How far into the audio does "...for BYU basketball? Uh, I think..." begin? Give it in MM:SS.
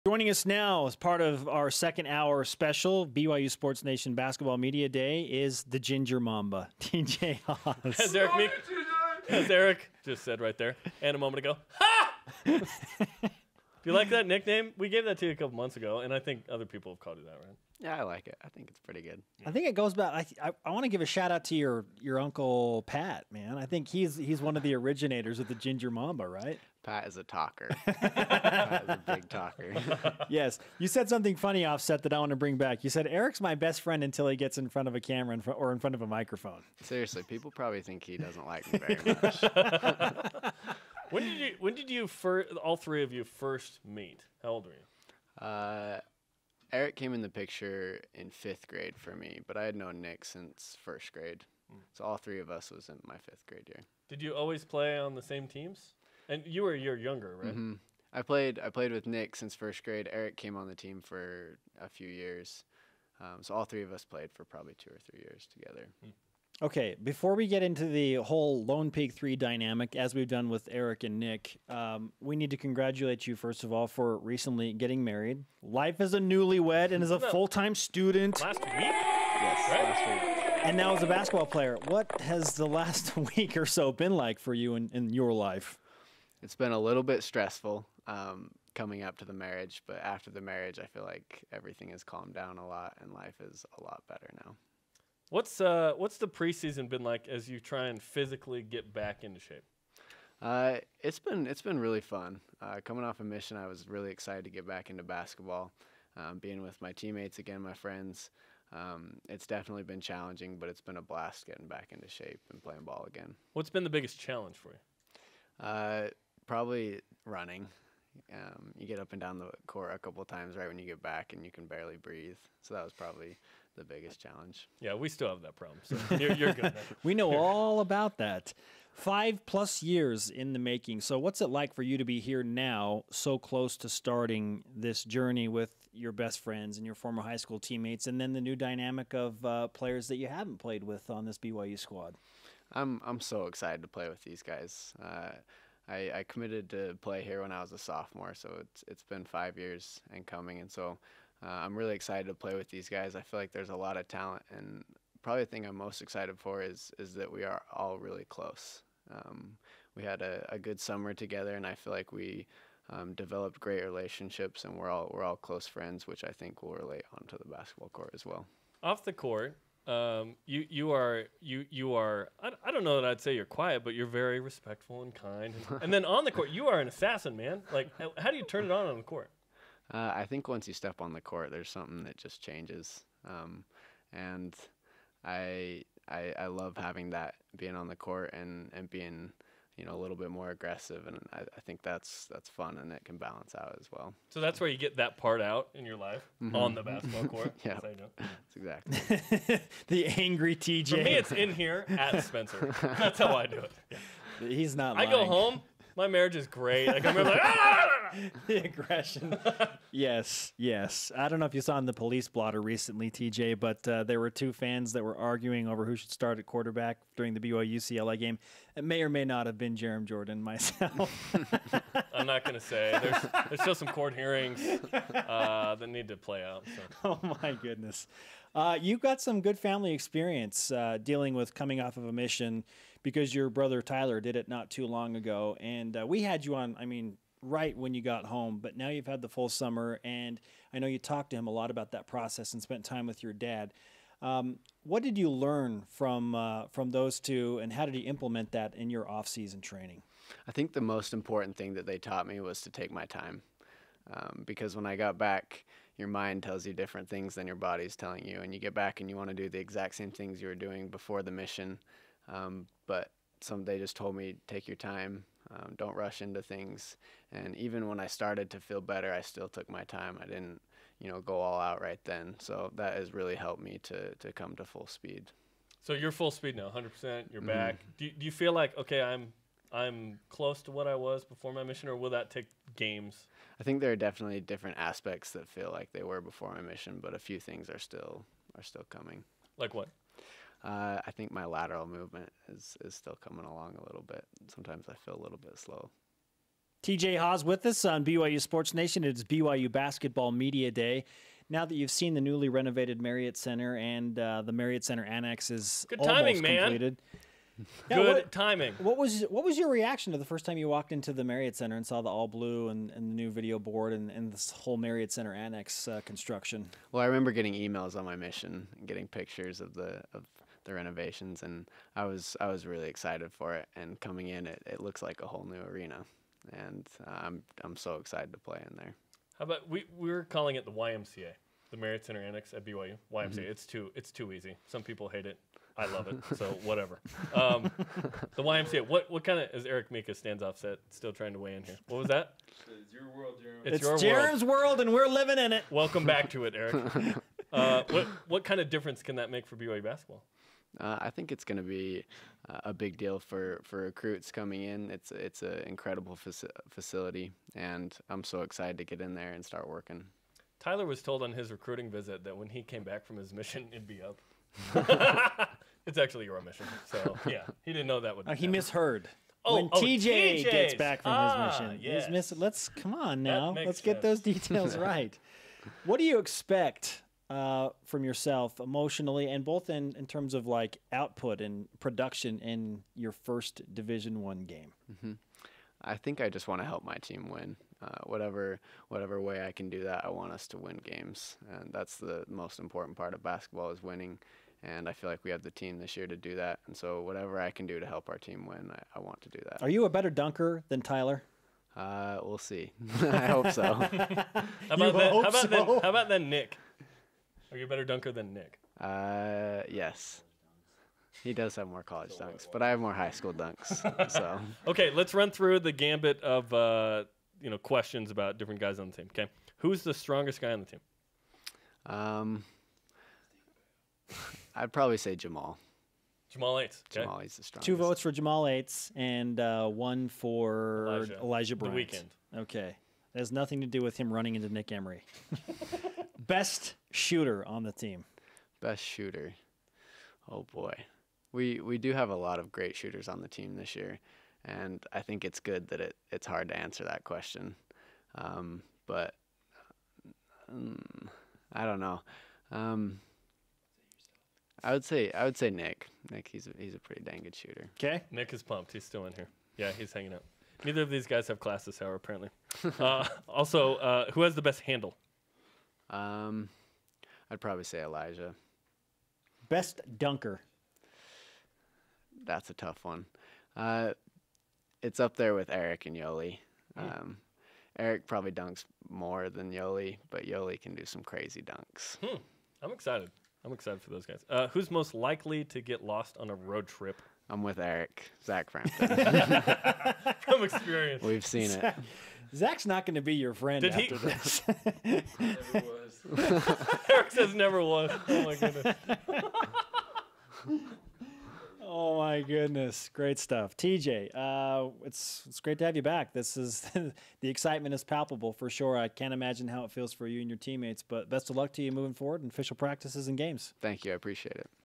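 05:49.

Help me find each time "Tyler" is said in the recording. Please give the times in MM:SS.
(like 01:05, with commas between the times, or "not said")
03:53, 06:00, 06:40.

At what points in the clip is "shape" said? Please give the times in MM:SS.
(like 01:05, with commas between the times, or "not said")
01:39, 01:52.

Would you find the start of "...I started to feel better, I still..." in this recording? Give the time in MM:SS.
04:27.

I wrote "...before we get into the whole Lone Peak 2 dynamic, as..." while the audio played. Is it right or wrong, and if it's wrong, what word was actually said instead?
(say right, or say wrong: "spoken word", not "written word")
wrong: "3", not "2".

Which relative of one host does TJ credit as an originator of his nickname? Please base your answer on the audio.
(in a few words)
Uncle Pat.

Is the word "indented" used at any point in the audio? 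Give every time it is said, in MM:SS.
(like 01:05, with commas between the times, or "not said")
not said.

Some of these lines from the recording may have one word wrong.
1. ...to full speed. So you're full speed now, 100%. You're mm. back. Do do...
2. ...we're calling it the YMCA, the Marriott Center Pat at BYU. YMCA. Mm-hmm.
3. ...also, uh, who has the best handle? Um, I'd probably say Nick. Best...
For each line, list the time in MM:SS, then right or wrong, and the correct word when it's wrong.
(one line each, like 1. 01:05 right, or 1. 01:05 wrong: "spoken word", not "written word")
1. 04:34 right
2. 05:29 wrong: "Annex", not "Pat"
3. 07:43 wrong: "Elijah", not "Nick".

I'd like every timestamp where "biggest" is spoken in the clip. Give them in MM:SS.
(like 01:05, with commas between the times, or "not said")
01:53, 02:03.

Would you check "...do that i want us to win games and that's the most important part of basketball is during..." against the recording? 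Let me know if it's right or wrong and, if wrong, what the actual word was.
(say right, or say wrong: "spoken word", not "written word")
wrong: "winning", not "during".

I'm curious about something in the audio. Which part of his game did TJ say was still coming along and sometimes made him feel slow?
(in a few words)
Lateral movement.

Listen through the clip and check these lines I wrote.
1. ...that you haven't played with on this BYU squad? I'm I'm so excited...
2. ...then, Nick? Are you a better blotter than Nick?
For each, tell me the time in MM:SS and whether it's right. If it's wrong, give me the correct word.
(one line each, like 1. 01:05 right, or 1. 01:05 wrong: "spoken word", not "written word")
1. 02:20 right
2. 06:46 wrong: "dunker", not "blotter".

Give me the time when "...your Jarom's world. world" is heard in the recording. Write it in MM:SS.
05:44.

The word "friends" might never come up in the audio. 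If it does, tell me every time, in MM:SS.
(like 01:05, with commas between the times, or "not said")
00:33, 01:47, 02:16, 02:45, 08:13.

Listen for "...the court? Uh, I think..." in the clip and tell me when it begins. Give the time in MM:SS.
02:58.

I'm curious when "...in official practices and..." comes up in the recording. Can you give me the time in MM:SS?
08:32.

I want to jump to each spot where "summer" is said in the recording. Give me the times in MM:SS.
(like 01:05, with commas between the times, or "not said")
02:40, 03:59.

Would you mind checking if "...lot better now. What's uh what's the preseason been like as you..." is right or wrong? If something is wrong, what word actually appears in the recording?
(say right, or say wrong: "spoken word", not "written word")
right.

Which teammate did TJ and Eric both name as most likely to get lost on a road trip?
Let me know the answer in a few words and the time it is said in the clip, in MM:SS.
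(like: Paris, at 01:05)
Zach Frampton, at 08:08.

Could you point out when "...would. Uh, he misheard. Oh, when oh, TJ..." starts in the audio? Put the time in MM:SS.
06:08.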